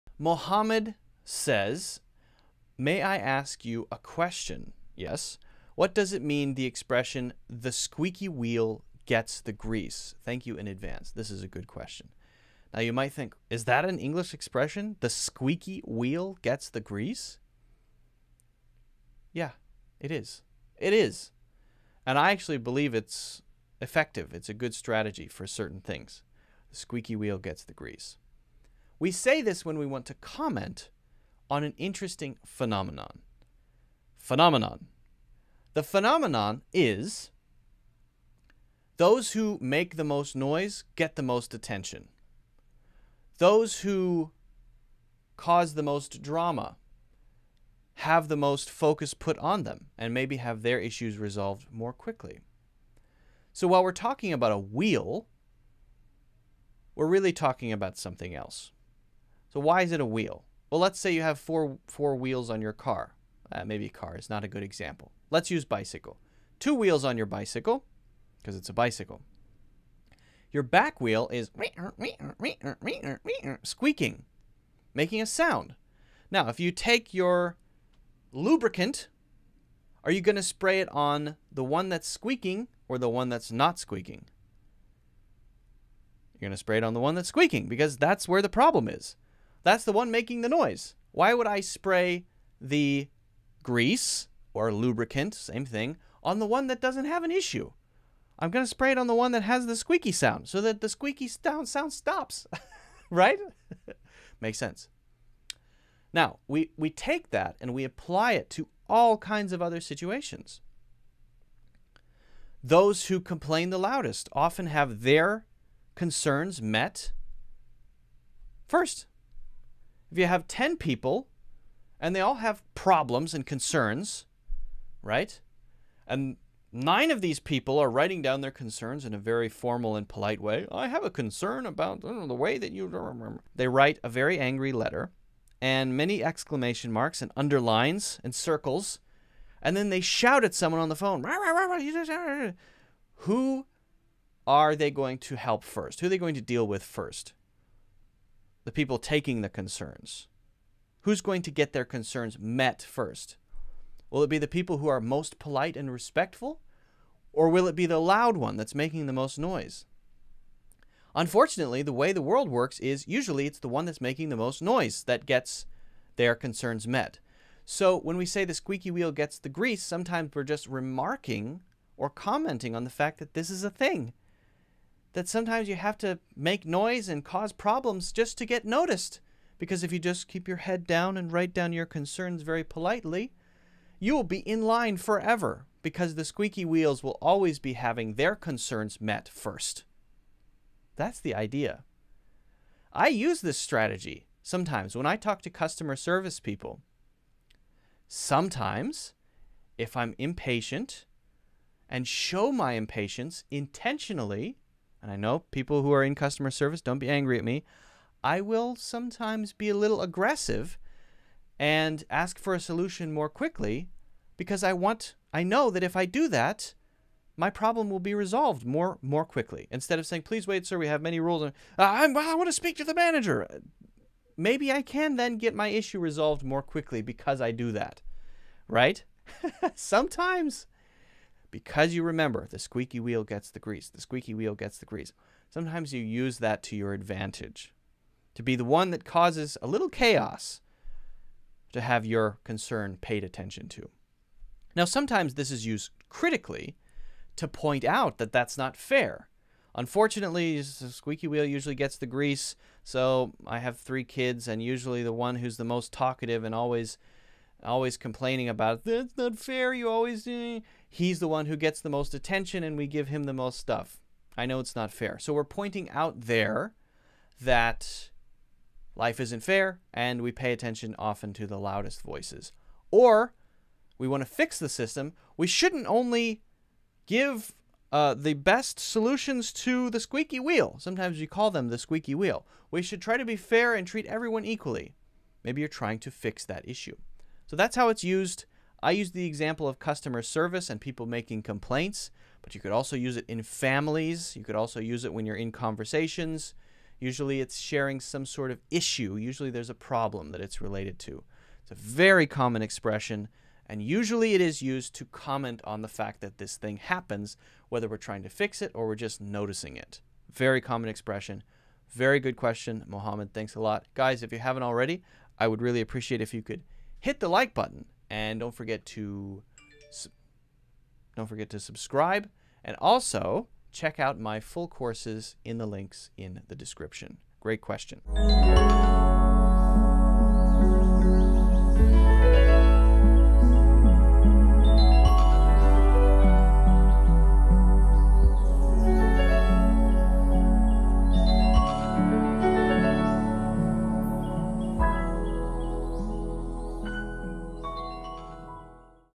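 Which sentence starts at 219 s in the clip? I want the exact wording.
Instead of saying, "Please wait, sir, we have many rules," and uh, I, I want to speak to the manager.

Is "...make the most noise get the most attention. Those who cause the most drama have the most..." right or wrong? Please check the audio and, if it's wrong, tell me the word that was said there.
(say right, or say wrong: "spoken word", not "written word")
right.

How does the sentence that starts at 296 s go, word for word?
Usually it's sharing some sort of issue.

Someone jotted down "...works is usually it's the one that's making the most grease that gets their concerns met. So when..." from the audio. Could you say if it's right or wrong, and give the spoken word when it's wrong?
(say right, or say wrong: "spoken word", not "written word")
wrong: "noise", not "grease".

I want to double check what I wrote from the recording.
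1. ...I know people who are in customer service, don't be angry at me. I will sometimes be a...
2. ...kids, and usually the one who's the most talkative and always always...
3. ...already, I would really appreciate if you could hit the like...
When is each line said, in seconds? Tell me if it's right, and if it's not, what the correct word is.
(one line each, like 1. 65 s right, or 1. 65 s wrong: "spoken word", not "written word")
1. 205 s right
2. 254 s right
3. 314 s right.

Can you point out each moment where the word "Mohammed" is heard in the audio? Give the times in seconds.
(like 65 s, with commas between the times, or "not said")
0 s, 312 s.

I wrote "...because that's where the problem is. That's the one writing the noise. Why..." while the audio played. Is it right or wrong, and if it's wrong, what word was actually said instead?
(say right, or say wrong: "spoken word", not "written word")
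wrong: "making", not "writing".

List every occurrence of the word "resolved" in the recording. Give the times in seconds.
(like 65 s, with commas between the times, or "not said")
51 s, 218 s, 225 s.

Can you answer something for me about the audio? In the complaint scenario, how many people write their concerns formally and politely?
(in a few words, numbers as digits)
9.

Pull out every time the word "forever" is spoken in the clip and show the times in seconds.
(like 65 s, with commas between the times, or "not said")
184 s.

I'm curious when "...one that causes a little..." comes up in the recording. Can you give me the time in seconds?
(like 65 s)
238 s.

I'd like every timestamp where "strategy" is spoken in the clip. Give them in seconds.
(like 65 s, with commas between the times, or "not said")
24 s, 193 s.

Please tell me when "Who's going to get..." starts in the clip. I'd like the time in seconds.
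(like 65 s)
151 s.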